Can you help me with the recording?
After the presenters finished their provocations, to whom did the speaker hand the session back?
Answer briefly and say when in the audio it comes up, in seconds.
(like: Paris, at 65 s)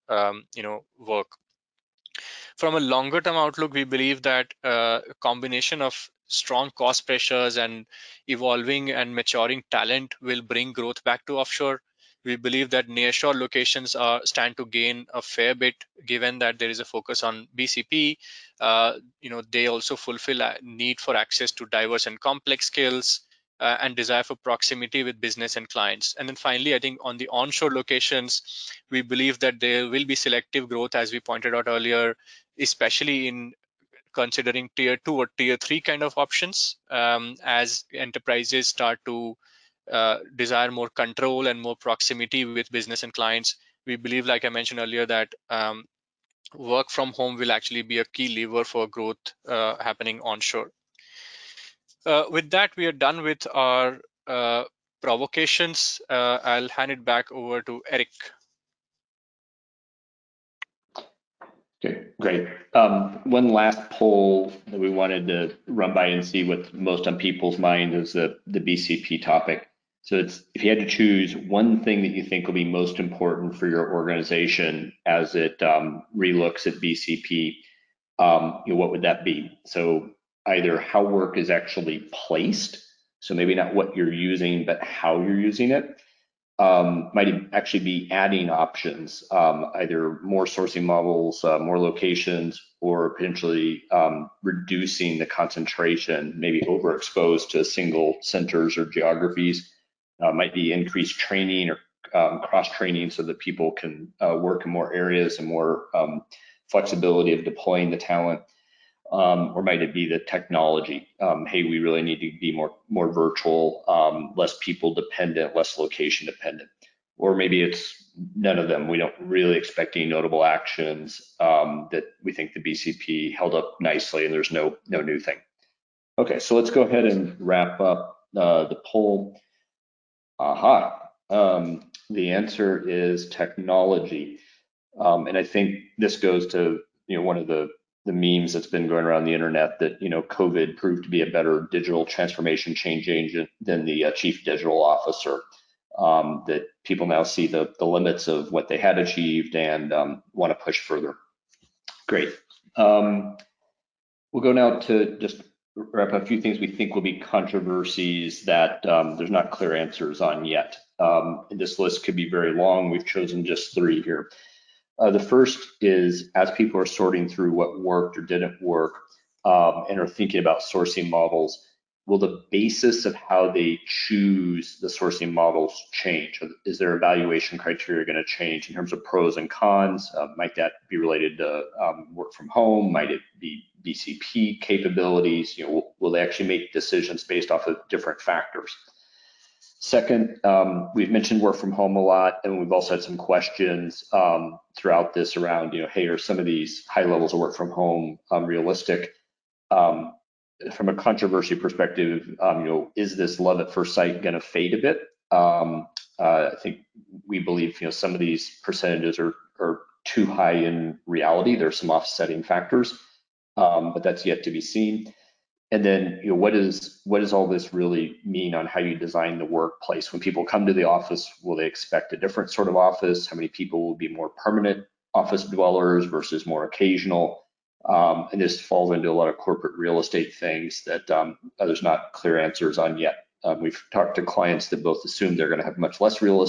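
Eric, at 57 s.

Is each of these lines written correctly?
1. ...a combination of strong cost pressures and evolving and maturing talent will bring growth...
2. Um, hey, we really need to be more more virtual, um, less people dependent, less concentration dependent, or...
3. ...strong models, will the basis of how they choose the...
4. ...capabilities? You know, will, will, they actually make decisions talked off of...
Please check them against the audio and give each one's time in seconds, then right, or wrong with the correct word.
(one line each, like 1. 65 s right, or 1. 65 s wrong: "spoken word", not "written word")
1. 5 s right
2. 111 s wrong: "location", not "concentration"
3. 170 s wrong: "sourcing", not "strong"
4. 184 s wrong: "based", not "talked".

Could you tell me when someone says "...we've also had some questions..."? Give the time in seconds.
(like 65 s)
192 s.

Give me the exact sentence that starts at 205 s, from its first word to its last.
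Um, uh, I think we believe, you know, some of these percentages are, are too high in reality.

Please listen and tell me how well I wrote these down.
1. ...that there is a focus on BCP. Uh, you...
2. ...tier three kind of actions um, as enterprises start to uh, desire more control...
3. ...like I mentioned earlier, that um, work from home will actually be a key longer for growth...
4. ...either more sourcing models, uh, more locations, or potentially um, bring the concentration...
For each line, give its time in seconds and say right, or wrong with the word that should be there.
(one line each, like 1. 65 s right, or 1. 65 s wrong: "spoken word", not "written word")
1. 16 s right
2. 35 s wrong: "options", not "actions"
3. 44 s wrong: "lever", not "longer"
4. 89 s wrong: "reducing", not "bring".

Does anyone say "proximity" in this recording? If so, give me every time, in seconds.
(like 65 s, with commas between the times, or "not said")
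24 s, 41 s.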